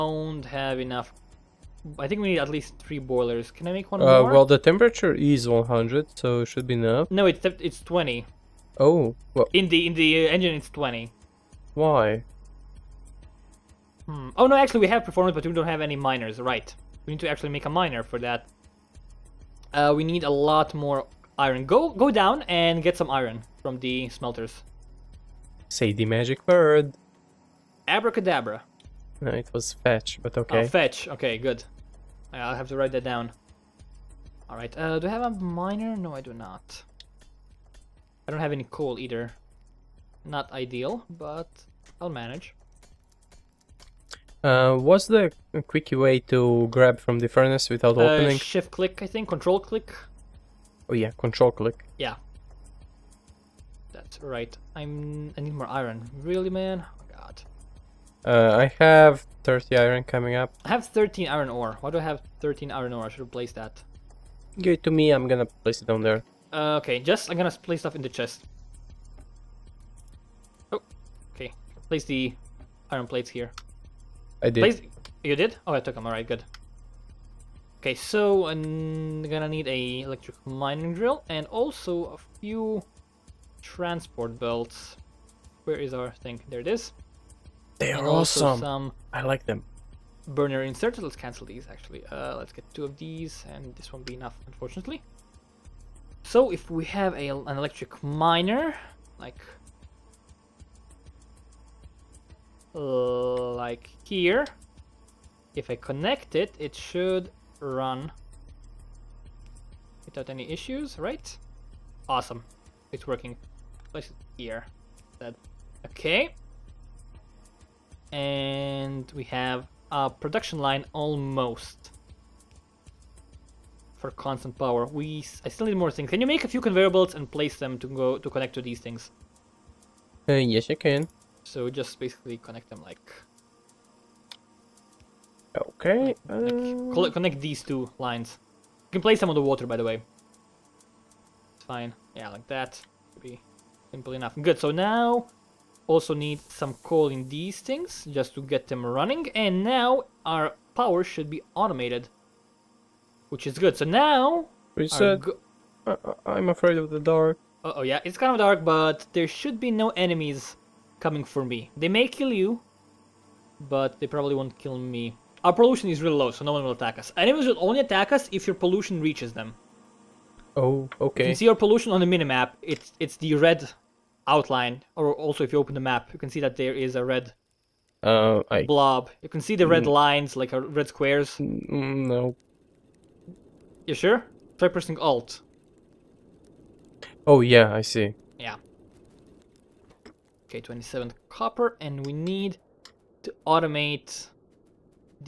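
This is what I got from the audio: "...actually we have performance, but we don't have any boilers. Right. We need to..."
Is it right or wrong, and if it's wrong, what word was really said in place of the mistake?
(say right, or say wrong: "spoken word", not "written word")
wrong: "miners", not "boilers".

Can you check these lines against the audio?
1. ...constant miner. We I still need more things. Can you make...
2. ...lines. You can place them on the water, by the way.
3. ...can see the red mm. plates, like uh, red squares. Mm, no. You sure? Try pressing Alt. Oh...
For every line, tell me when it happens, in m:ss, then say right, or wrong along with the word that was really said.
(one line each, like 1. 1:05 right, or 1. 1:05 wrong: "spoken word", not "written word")
1. 2:04 wrong: "power", not "miner"
2. 2:17 right
3. 2:59 wrong: "lines", not "plates".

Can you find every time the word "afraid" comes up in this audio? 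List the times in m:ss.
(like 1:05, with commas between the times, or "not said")
2:36.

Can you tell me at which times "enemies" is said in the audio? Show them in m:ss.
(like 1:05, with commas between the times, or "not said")
2:39, 2:47.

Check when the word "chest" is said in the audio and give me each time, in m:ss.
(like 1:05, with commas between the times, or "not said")
1:08.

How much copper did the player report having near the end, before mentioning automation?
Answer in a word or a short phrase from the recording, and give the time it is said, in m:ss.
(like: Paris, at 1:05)
27, at 3:10.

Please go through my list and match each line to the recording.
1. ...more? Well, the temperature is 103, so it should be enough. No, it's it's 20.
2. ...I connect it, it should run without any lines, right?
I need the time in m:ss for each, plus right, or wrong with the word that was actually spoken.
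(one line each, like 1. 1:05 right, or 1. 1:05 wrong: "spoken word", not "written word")
1. 0:04 wrong: "100", not "103"
2. 1:45 wrong: "issues", not "lines".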